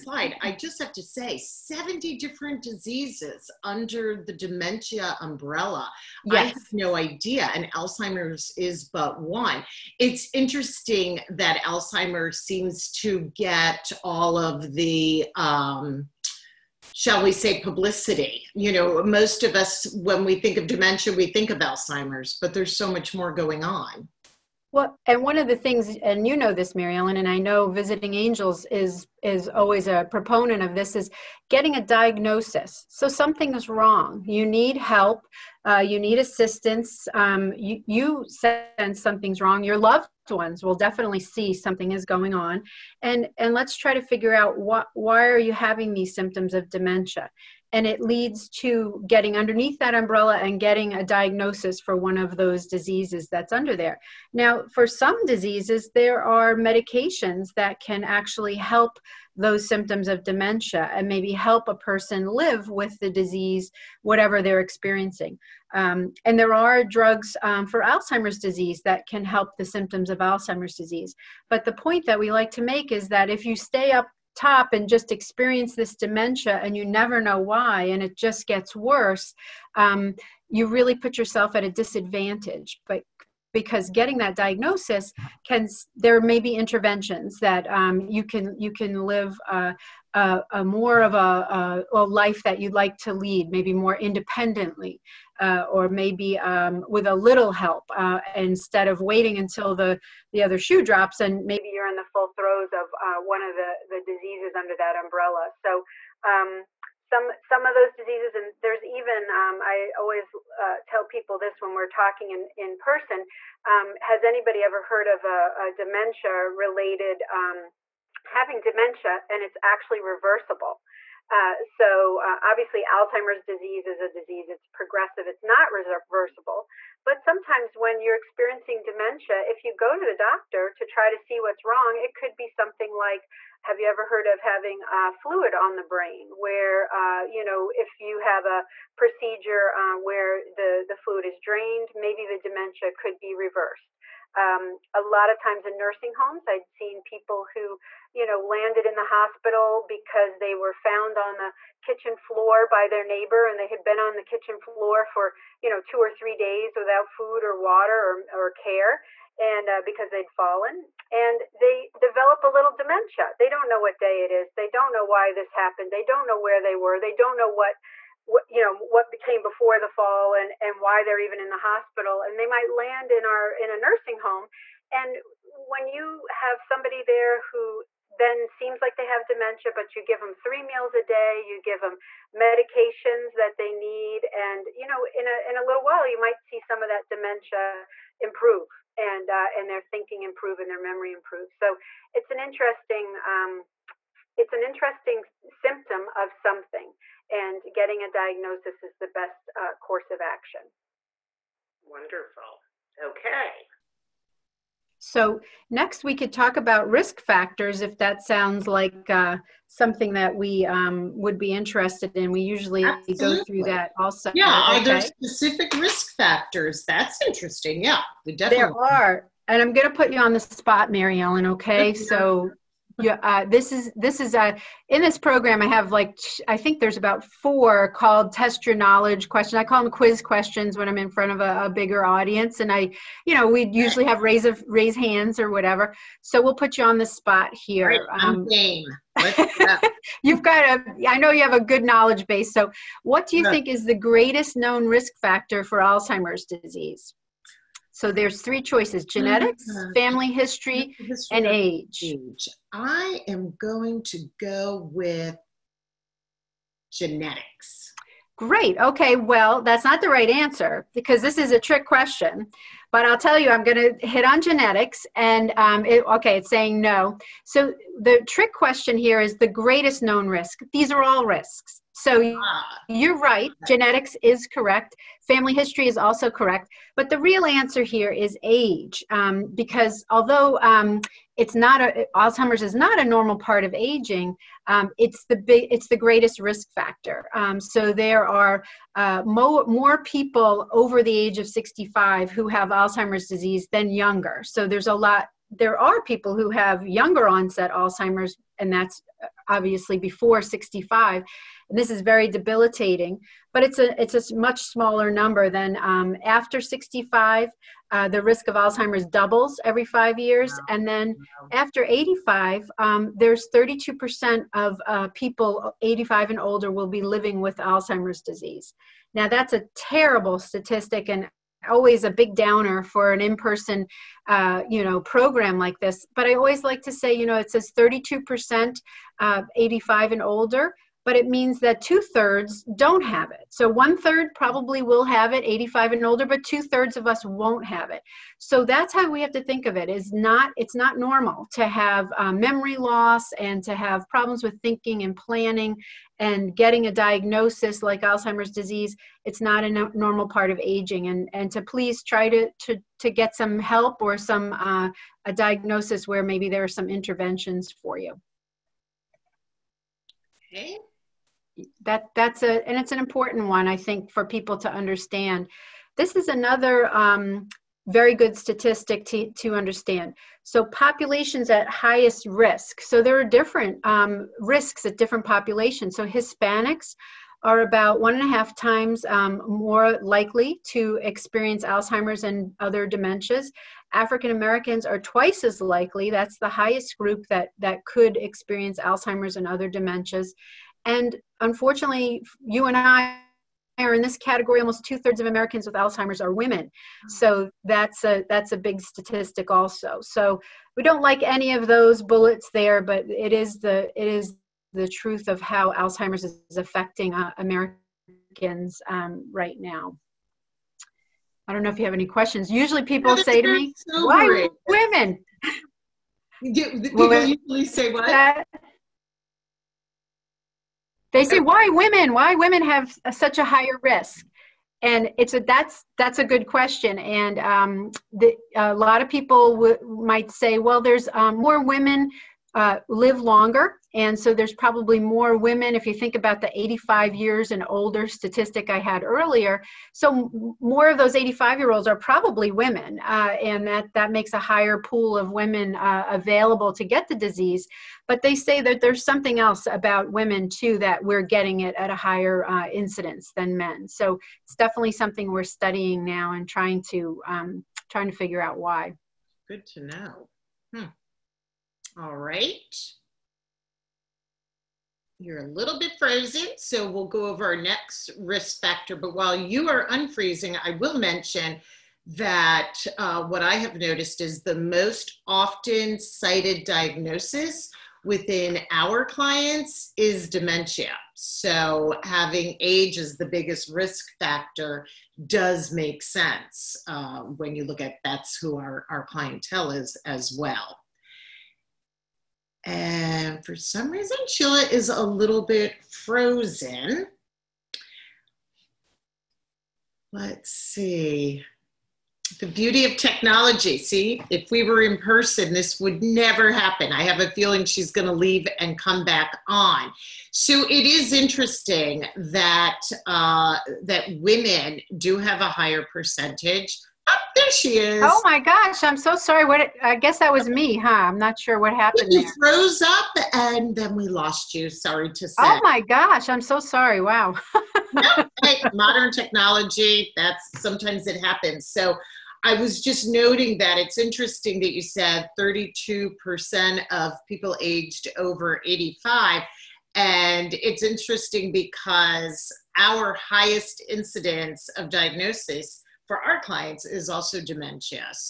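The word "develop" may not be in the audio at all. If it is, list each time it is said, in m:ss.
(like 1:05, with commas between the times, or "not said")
2:41.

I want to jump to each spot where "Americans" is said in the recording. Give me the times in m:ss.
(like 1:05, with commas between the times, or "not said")
6:24, 6:35, 6:47.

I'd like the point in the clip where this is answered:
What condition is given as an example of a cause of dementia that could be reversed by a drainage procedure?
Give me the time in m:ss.
2:15.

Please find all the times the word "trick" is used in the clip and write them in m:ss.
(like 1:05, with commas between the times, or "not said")
4:21, 4:28.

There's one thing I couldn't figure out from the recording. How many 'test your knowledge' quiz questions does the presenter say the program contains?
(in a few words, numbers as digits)
About 4.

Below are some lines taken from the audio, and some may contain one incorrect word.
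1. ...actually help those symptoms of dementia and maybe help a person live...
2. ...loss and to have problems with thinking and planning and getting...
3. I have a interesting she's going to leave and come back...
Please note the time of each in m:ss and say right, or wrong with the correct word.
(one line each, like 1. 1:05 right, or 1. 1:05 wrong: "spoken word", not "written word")
1. 0:58 right
2. 5:42 right
3. 8:26 wrong: "feeling", not "interesting".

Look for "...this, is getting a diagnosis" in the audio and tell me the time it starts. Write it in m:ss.
0:30.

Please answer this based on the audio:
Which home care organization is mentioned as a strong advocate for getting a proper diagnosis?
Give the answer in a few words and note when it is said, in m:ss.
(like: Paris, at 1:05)
Visiting Angels, at 0:27.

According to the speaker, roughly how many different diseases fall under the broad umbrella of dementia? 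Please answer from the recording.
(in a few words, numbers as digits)
70.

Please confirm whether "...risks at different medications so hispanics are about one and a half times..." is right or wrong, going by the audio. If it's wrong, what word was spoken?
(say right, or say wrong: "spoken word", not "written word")
wrong: "populations", not "medications".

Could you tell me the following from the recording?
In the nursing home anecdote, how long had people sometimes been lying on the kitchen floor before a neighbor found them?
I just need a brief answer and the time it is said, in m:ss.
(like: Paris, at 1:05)
2 or 3 days, at 2:35.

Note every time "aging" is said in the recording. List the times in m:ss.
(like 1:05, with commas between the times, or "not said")
4:43, 5:50.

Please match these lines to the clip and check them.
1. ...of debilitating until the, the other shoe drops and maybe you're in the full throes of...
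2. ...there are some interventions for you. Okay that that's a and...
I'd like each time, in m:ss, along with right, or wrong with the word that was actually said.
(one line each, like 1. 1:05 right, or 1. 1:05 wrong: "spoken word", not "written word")
1. 1:38 wrong: "waiting", not "debilitating"
2. 5:56 right.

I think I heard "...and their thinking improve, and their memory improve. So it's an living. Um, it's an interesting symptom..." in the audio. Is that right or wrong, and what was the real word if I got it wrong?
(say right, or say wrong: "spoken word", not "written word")
wrong: "interesting", not "living".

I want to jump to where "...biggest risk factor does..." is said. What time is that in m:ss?
8:03.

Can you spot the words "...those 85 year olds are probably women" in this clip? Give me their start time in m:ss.
7:20.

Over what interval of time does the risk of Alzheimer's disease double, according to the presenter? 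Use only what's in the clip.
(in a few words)
5 years.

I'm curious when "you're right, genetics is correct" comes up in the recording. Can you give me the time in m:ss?
4:32.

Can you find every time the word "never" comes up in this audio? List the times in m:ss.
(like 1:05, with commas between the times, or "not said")
1:16, 8:26.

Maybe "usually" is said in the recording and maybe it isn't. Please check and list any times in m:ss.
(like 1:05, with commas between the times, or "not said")
3:32, 3:53, 6:52, 6:57.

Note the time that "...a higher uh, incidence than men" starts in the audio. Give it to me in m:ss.
7:31.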